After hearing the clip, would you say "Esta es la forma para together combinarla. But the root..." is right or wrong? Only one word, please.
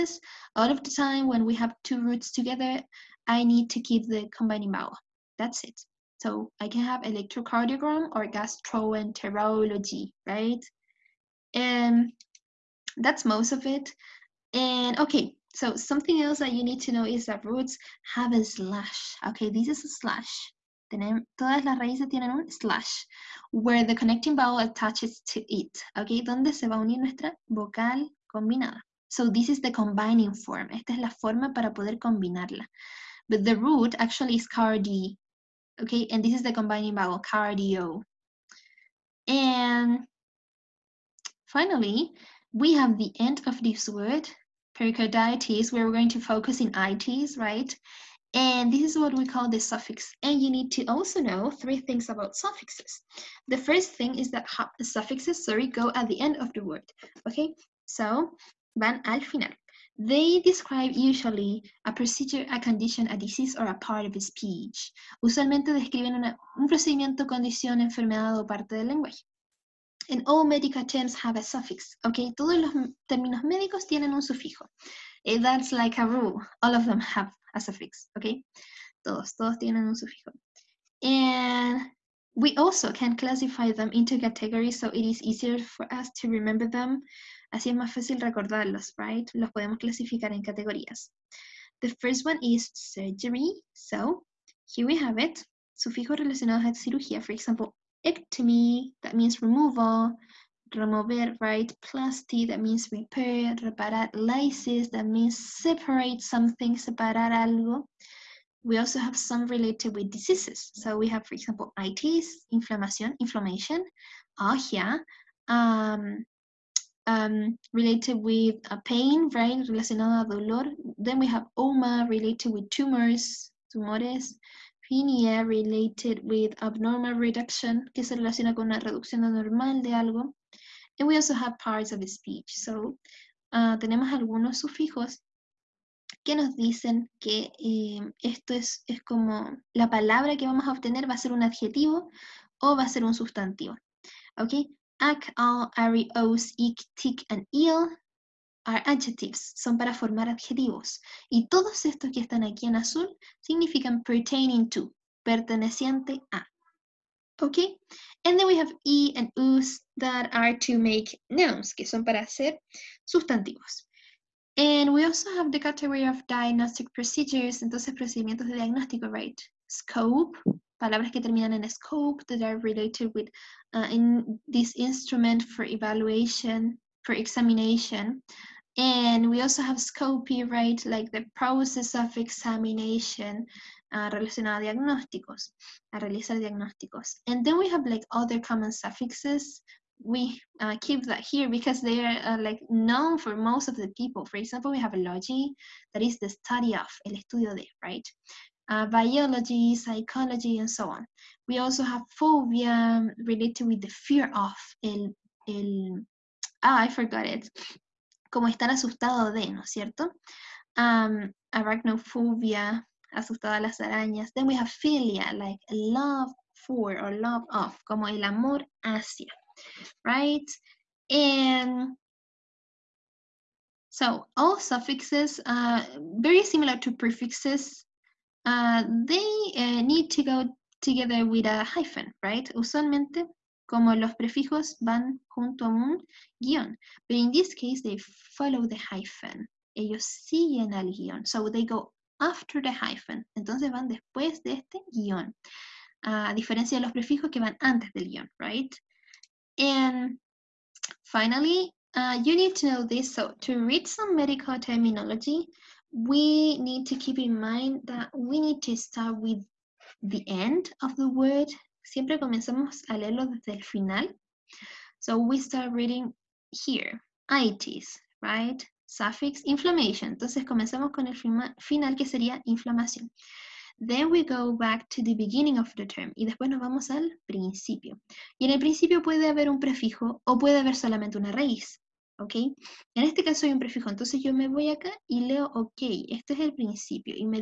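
wrong.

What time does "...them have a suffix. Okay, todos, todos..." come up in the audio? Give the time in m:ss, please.
1:16.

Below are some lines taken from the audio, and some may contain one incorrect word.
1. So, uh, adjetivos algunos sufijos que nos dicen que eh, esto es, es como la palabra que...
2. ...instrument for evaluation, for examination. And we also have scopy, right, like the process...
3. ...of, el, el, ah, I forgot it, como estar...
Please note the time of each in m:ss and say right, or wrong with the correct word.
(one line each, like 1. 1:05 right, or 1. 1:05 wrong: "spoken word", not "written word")
1. 2:12 wrong: "tenemos", not "adjetivos"
2. 2:54 right
3. 3:24 right.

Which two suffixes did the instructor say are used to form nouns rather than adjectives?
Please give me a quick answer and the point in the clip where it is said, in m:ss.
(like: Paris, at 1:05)
e and us, at 2:38.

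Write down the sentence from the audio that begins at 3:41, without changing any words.
And so all suffixes, uh, very similar to prefixes, uh, ah, they uh, eh, need to go together with a hyphen, right?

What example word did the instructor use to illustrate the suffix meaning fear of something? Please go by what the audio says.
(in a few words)
arachnophobia.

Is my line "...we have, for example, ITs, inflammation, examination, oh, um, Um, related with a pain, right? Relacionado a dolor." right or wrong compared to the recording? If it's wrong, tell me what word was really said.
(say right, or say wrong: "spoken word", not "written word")
wrong: "inflammation", not "examination".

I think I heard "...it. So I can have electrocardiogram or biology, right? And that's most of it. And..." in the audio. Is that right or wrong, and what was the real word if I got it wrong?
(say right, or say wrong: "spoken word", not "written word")
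wrong: "gastroenterology", not "biology".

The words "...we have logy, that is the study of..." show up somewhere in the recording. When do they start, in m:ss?
3:14.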